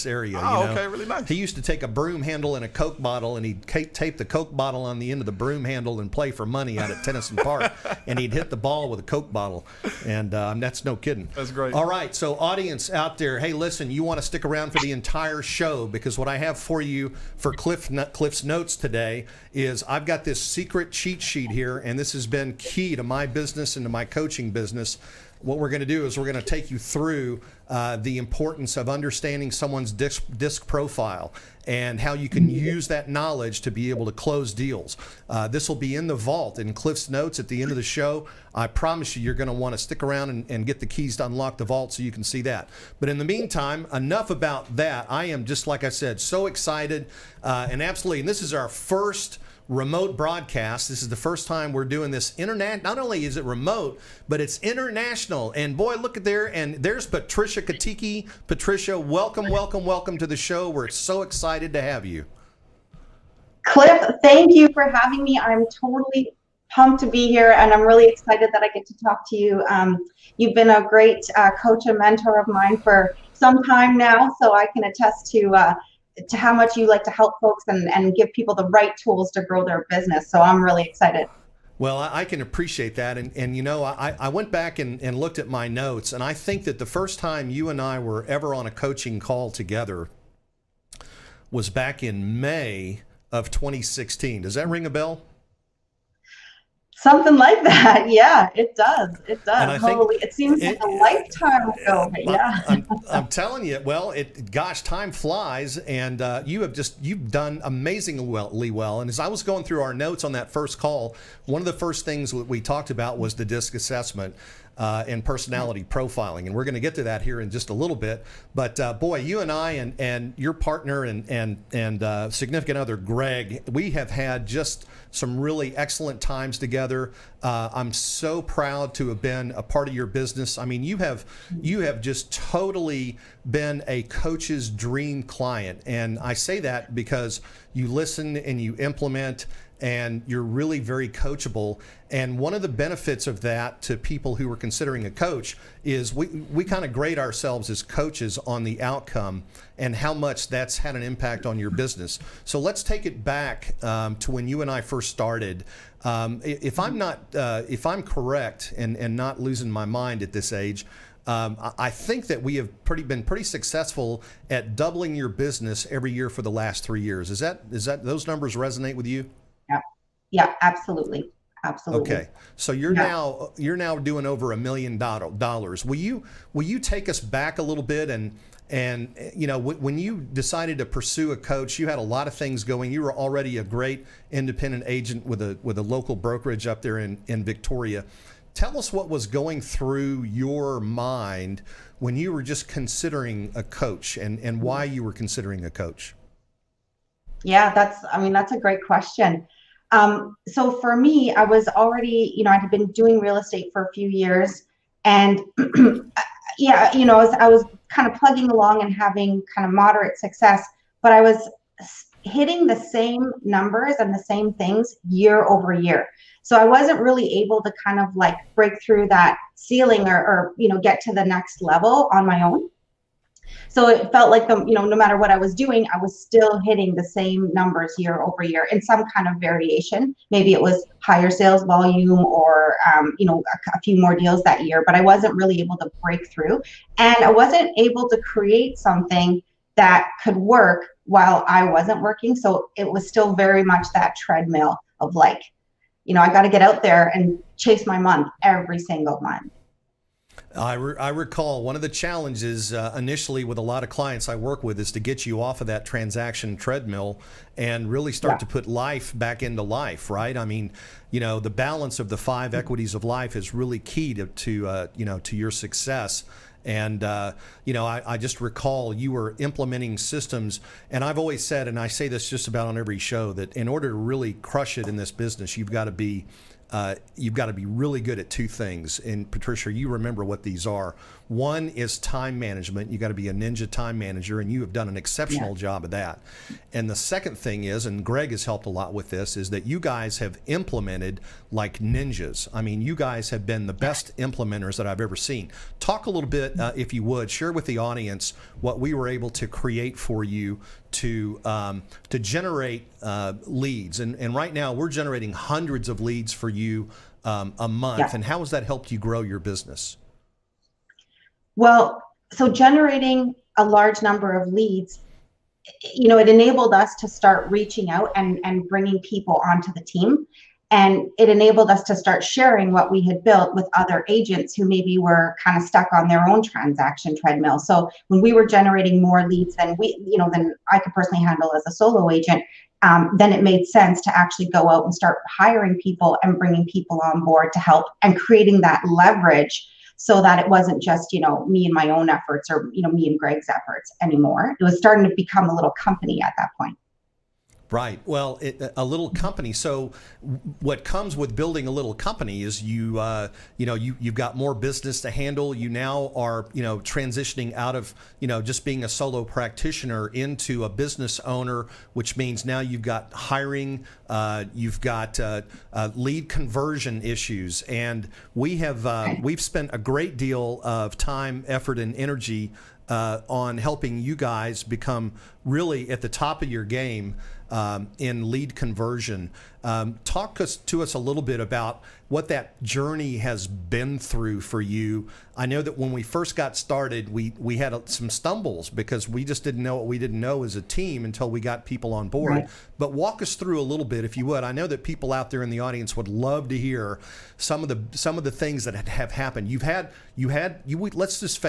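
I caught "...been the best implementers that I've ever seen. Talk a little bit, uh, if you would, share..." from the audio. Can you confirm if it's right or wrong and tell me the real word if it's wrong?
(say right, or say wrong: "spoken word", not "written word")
right.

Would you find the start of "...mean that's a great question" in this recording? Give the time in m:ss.
3:18.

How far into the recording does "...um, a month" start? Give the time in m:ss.
5:07.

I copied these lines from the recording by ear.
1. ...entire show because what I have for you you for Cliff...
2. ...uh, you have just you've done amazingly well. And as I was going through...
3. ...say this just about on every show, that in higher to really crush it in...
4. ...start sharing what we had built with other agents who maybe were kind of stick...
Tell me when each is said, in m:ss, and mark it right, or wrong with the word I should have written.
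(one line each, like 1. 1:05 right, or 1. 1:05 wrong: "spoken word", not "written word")
1. 0:14 right
2. 1:46 right
3. 4:31 wrong: "order", not "higher"
4. 5:21 wrong: "stuck", not "stick".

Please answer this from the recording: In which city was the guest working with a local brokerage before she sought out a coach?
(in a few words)
Victoria.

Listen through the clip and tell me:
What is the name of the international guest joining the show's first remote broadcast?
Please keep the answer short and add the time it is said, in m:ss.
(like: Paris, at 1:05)
Patricia Kiteke, at 0:57.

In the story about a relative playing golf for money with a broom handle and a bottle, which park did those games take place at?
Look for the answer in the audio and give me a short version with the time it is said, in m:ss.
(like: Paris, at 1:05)
Tenison Park, at 0:07.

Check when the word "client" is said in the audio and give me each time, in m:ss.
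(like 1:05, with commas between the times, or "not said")
2:15, 4:13.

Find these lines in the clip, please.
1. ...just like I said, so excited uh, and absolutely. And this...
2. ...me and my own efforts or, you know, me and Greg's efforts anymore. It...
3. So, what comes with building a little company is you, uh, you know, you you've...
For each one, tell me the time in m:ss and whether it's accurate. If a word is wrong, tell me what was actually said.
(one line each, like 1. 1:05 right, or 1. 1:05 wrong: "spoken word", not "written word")
1. 0:45 right
2. 5:41 right
3. 5:49 right.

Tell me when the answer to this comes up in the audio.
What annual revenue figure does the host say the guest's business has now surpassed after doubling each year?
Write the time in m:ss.
2:54.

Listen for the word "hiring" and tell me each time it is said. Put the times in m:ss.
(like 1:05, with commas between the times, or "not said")
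5:35, 6:03.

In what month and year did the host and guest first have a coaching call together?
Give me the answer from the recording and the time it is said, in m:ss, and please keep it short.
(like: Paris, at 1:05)
May 2016, at 1:32.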